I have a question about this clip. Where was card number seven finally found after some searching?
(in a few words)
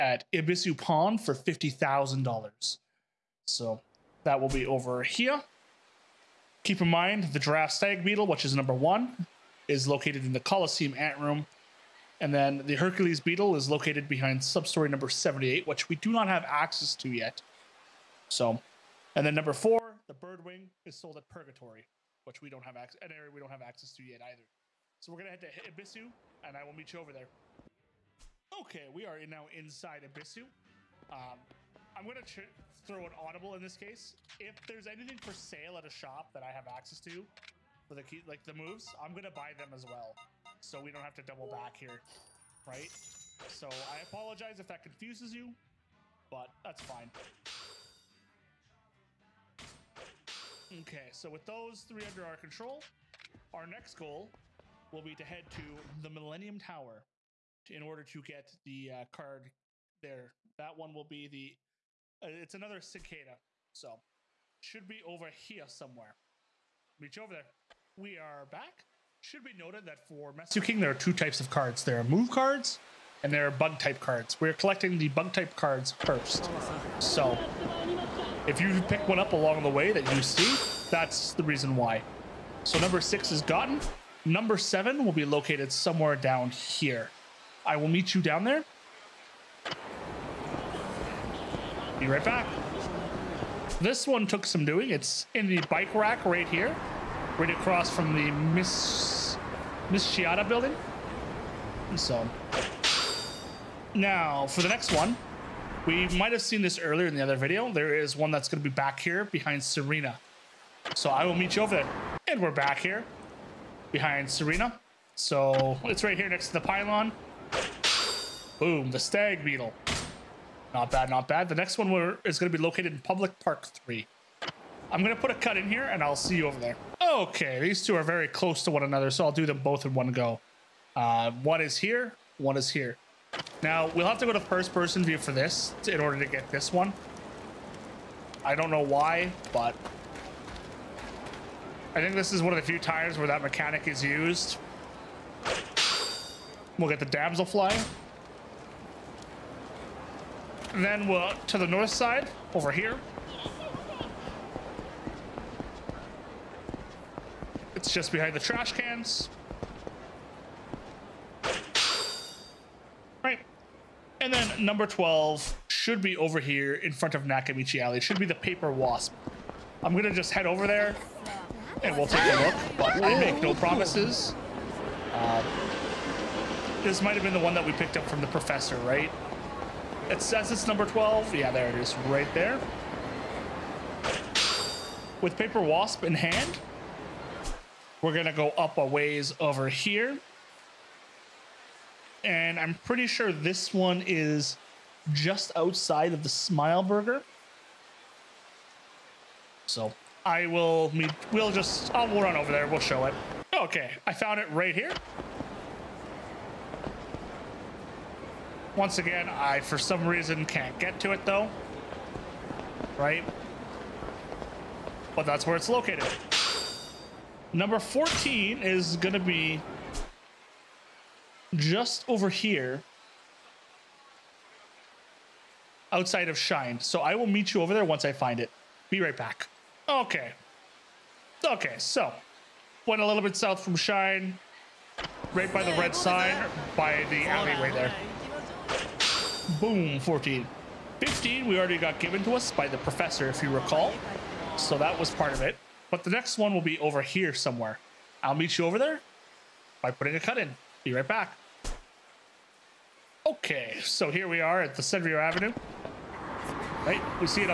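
In the bike rack.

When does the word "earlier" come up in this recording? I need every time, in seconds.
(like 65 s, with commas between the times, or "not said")
106 s.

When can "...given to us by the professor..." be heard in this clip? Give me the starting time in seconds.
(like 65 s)
242 s.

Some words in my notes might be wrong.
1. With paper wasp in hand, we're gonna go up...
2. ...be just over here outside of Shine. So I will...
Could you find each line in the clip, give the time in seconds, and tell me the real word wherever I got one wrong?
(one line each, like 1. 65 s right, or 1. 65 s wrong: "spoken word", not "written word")
1. 185 s right
2. 219 s right.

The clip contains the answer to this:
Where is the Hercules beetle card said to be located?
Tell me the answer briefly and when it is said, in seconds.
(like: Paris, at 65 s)
Behind substory number 78, at 14 s.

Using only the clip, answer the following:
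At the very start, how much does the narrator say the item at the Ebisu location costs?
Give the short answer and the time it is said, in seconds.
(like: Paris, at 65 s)
$50,000, at 1 s.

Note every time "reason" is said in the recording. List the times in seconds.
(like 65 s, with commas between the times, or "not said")
81 s, 210 s.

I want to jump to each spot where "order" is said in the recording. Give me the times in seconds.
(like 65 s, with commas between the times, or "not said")
57 s, 136 s.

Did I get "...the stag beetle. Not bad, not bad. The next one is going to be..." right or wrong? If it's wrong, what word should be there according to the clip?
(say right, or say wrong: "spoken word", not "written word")
right.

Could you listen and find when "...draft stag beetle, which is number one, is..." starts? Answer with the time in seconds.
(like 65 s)
7 s.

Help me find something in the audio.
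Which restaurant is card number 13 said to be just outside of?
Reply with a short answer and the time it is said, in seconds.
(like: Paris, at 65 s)
Smile Burger, at 196 s.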